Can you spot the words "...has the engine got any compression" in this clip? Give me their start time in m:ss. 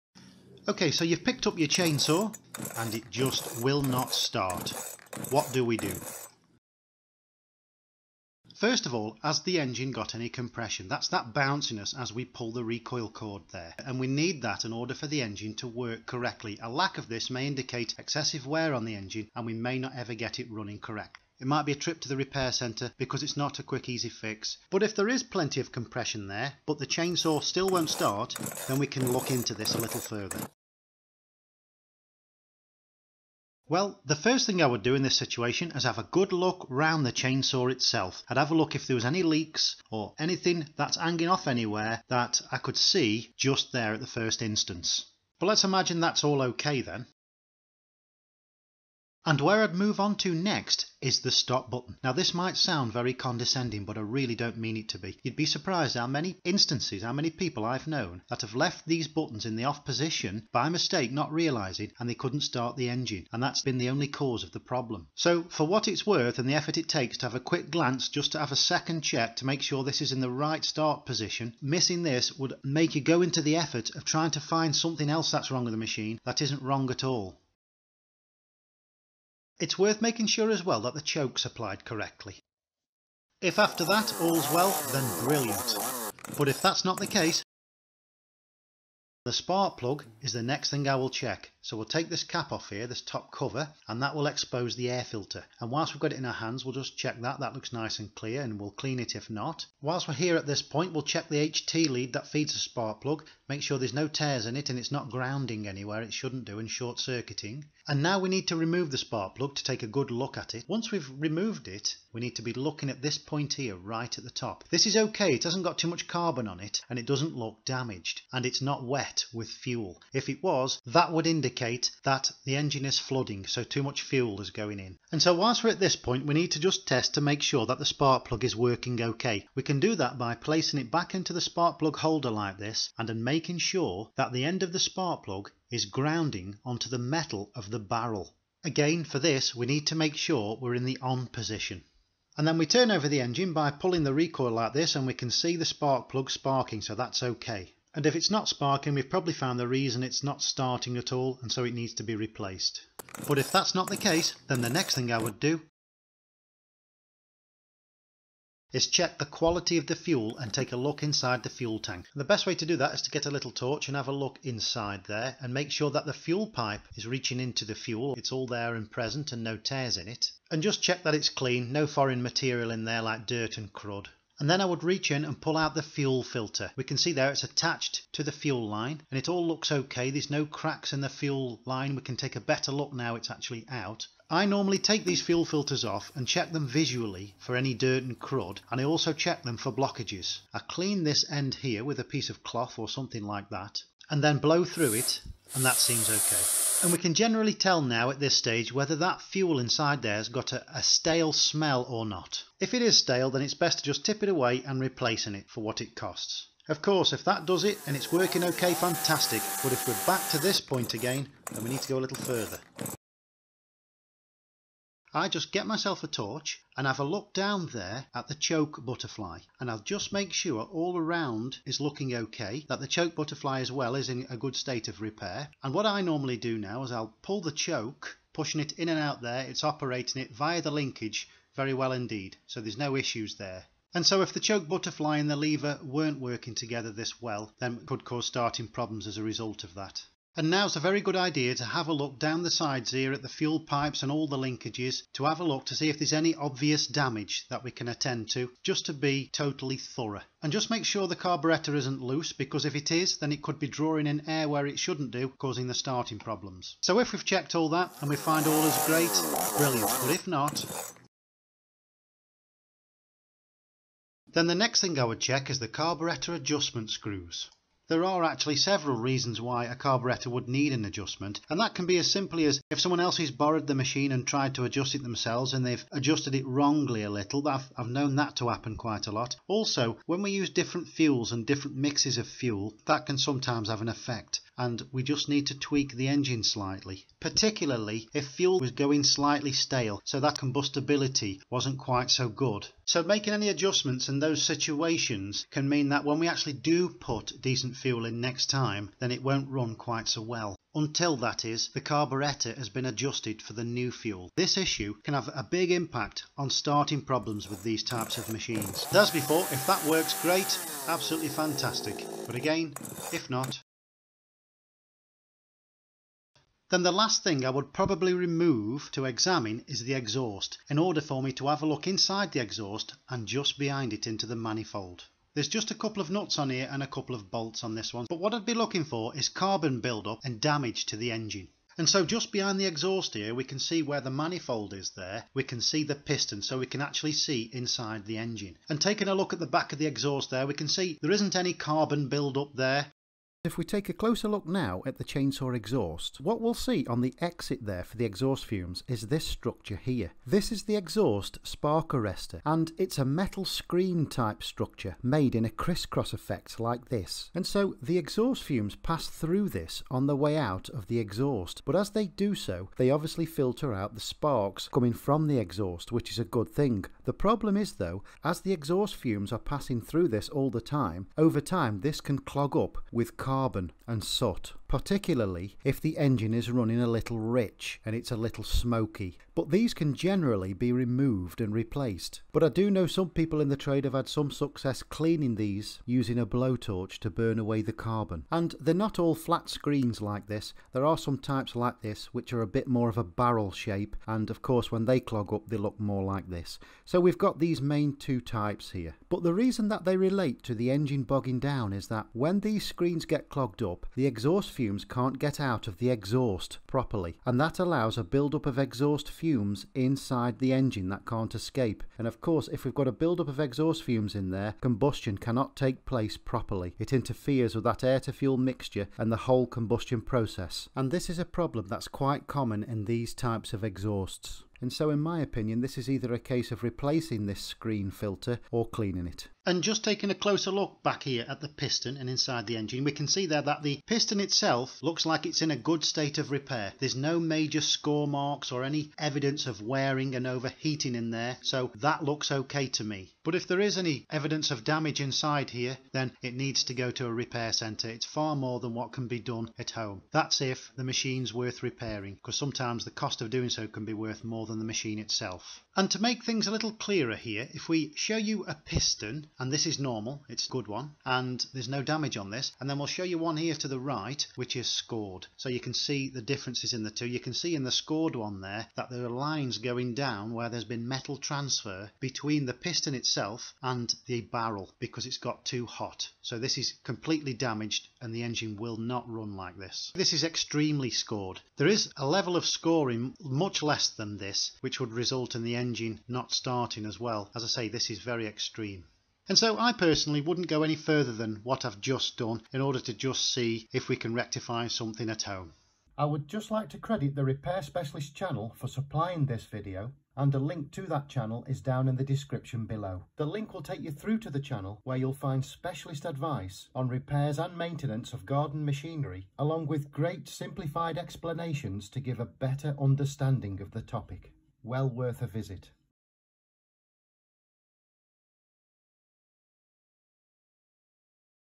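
0:09.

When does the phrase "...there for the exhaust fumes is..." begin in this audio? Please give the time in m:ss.
5:47.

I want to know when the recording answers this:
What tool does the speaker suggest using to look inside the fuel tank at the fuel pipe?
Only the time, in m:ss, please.
2:43.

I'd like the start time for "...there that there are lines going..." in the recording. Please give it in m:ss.
7:48.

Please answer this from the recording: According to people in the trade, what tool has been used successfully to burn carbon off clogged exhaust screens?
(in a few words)
A blowtorch.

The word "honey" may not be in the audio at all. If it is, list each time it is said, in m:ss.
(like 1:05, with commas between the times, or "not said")
not said.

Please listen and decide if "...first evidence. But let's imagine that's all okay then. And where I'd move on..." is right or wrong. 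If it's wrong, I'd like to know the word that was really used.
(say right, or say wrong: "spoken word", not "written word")
wrong: "instance", not "evidence".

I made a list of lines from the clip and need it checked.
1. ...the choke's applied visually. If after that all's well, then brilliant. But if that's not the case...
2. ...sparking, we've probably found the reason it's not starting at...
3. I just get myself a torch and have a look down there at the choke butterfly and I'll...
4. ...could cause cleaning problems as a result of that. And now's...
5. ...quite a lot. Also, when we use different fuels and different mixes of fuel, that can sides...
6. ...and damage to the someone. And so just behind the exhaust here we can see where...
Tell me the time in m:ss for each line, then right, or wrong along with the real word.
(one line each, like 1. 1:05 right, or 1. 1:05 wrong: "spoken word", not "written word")
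1. 1:20 wrong: "correctly", not "visually"
2. 2:28 right
3. 3:35 right
4. 3:57 wrong: "starting", not "cleaning"
5. 4:38 wrong: "sometimes", not "sides"
6. 5:30 wrong: "engine", not "someone".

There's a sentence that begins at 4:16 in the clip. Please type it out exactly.
So if we've checked all that and we find all is great, brilliant.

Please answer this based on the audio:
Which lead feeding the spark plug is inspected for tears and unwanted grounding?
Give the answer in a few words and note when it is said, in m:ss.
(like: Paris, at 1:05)
HT lead, at 1:41.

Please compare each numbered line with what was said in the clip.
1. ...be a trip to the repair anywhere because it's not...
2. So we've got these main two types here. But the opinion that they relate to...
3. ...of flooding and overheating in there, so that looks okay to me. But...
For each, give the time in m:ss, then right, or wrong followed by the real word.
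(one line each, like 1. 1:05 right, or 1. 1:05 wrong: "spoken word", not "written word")
1. 0:21 wrong: "centre", not "anywhere"
2. 6:36 wrong: "reason", not "opinion"
3. 7:19 wrong: "wearing", not "flooding".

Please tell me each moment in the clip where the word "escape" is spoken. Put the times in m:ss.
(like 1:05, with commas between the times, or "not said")
6:51.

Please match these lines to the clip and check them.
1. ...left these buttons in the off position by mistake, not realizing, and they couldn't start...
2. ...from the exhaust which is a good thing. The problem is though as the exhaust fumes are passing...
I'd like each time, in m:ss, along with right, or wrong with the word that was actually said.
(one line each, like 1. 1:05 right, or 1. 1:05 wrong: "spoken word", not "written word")
1. 0:58 right
2. 6:04 right.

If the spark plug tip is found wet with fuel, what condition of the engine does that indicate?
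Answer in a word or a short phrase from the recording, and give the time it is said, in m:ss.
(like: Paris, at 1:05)
Flooding, at 2:02.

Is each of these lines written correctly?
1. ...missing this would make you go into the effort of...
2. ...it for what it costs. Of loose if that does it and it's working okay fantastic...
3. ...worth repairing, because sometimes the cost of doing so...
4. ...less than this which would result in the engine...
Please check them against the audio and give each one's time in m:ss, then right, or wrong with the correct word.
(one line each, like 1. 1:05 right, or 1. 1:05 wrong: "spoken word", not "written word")
1. 1:11 right
2. 3:25 wrong: "course", not "loose"
3. 7:31 right
4. 8:03 right.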